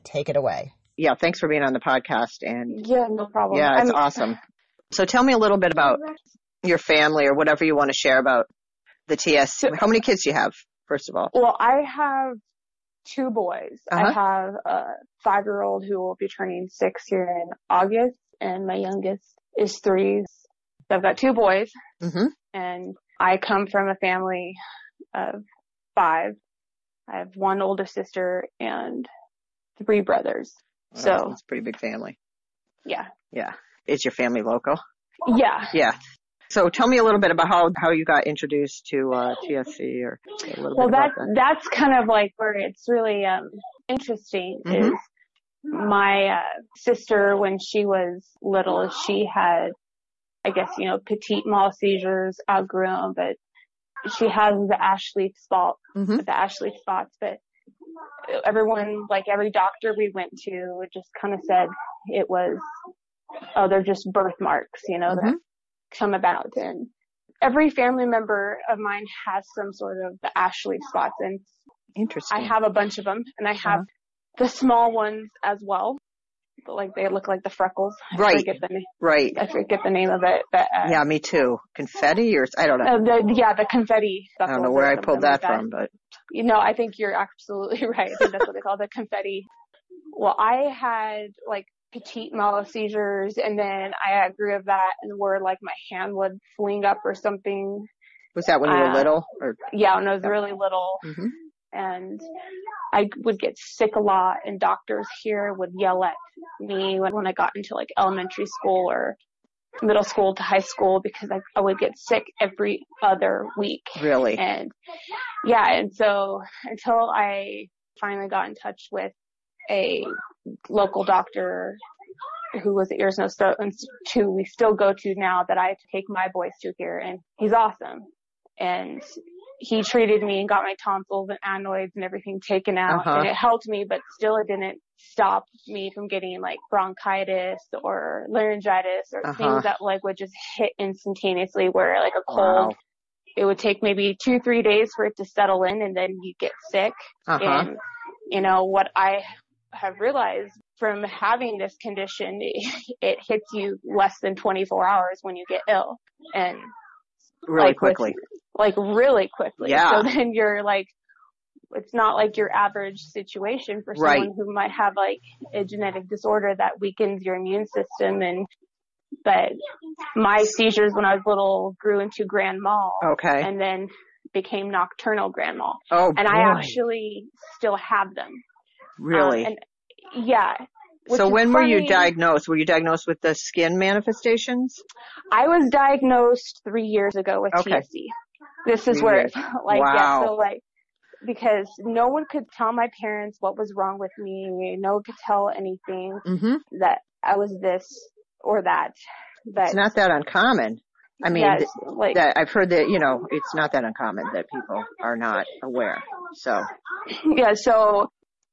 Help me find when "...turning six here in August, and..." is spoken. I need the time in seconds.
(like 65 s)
16 s.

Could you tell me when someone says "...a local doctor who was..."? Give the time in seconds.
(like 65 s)
119 s.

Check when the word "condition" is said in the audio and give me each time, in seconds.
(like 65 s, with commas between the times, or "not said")
151 s.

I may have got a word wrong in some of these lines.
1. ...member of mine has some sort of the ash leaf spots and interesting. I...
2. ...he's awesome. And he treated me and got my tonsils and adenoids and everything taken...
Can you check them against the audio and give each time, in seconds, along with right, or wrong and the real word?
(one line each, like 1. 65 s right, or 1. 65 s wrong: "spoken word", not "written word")
1. 68 s right
2. 127 s right.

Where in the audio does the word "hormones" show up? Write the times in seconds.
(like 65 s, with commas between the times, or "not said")
not said.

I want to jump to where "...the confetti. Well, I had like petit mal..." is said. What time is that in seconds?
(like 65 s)
88 s.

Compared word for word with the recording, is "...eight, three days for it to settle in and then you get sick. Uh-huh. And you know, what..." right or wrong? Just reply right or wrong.
wrong.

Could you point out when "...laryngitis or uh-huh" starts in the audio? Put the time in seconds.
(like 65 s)
138 s.